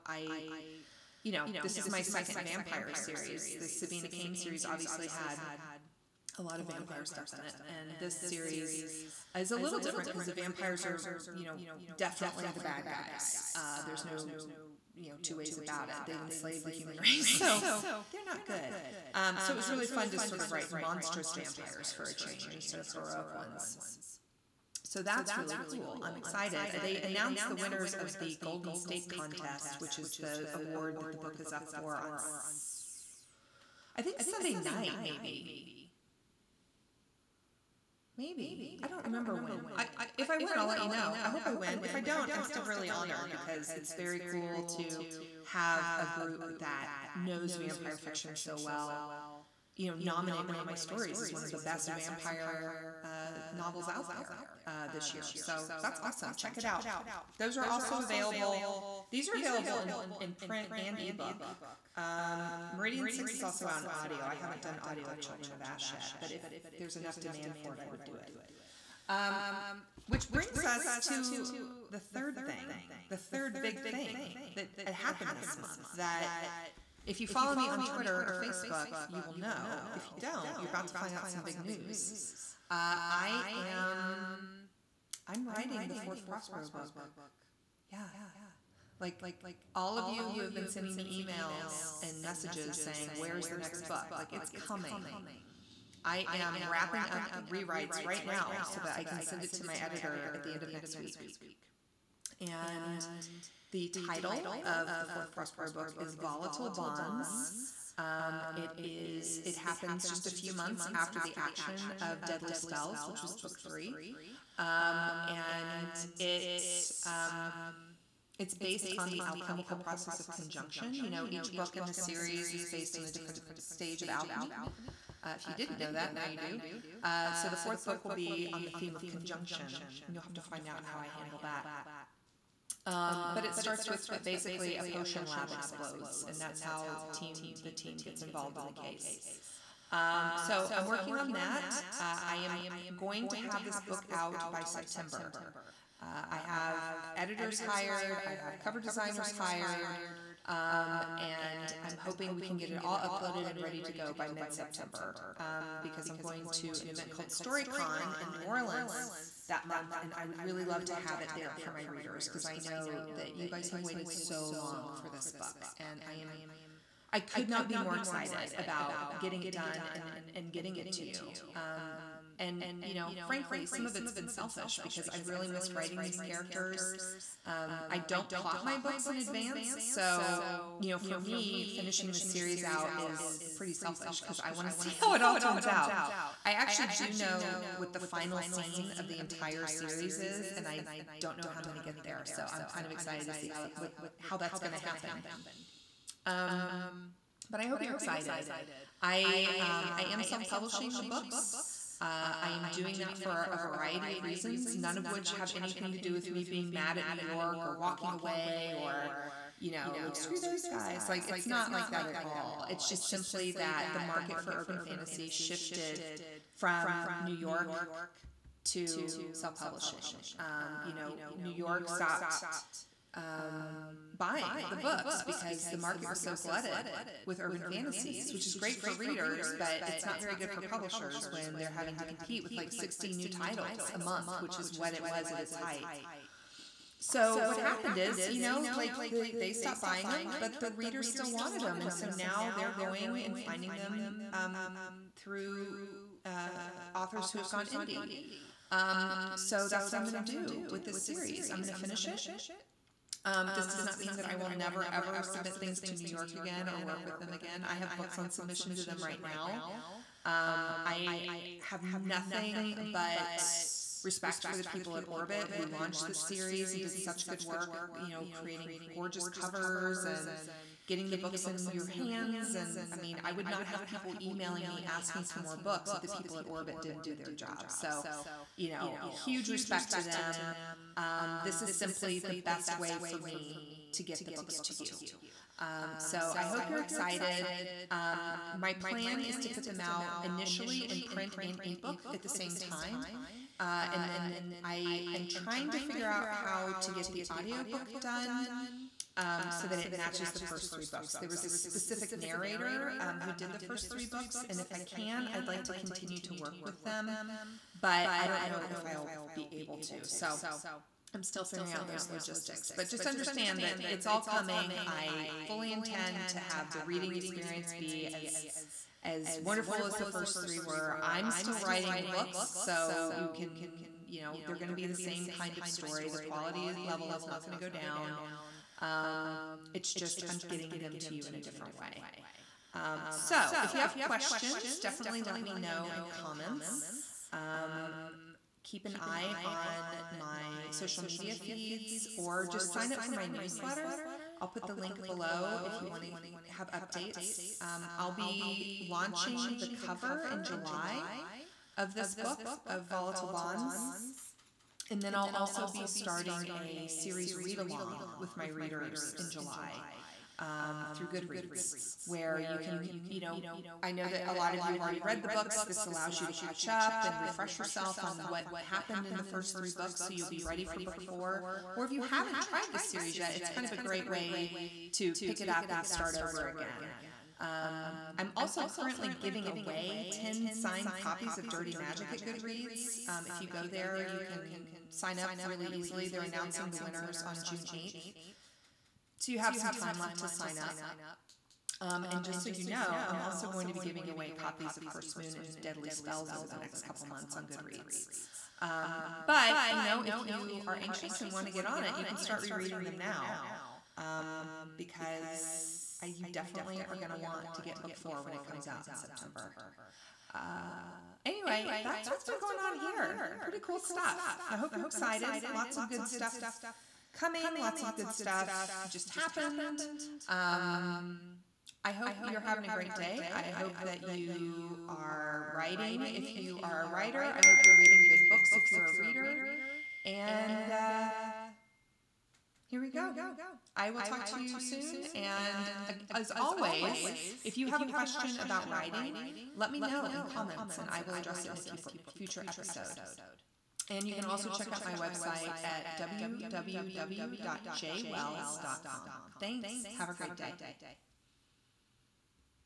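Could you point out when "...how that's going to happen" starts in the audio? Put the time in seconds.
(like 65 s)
194 s.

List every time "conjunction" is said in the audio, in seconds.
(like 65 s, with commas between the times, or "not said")
120 s, 129 s.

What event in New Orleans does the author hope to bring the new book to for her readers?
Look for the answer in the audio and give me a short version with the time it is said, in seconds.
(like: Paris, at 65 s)
StoryCon, at 157 s.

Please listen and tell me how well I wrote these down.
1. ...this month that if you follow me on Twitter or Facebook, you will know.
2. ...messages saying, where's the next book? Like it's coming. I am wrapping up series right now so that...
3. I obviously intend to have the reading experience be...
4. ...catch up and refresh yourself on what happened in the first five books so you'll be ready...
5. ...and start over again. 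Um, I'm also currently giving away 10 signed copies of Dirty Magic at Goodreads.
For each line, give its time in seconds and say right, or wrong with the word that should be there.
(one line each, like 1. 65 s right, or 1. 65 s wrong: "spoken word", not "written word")
1. 75 s right
2. 92 s wrong: "rewrites", not "series"
3. 314 s wrong: "fully", not "obviously"
4. 366 s wrong: "three", not "five"
5. 375 s right.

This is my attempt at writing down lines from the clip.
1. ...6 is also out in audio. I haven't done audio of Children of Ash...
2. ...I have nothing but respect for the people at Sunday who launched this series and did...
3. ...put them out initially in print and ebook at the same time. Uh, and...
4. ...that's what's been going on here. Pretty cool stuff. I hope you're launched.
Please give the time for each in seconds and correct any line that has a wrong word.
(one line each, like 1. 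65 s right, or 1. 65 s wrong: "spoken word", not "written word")
1. 63 s right
2. 260 s wrong: "Orbit", not "Sunday"
3. 289 s right
4. 411 s wrong: "excited", not "launched".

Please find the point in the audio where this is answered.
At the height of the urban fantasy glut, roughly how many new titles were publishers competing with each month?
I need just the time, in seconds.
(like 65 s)
232 s.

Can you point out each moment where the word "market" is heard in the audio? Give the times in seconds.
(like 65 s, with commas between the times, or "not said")
213 s, 225 s.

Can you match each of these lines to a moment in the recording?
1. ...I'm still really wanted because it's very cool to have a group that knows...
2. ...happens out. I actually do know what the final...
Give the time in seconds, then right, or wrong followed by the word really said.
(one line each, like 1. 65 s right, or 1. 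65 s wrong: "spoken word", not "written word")
1. 42 s wrong: "honored", not "wanted"
2. 185 s wrong: "turns", not "happens".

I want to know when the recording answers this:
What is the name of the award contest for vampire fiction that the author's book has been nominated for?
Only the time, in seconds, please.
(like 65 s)
28 s.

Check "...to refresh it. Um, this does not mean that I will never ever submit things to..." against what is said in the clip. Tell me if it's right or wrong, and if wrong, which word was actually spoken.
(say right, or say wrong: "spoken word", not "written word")
wrong: "finish", not "refresh".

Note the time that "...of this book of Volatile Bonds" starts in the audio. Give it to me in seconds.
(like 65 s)
351 s.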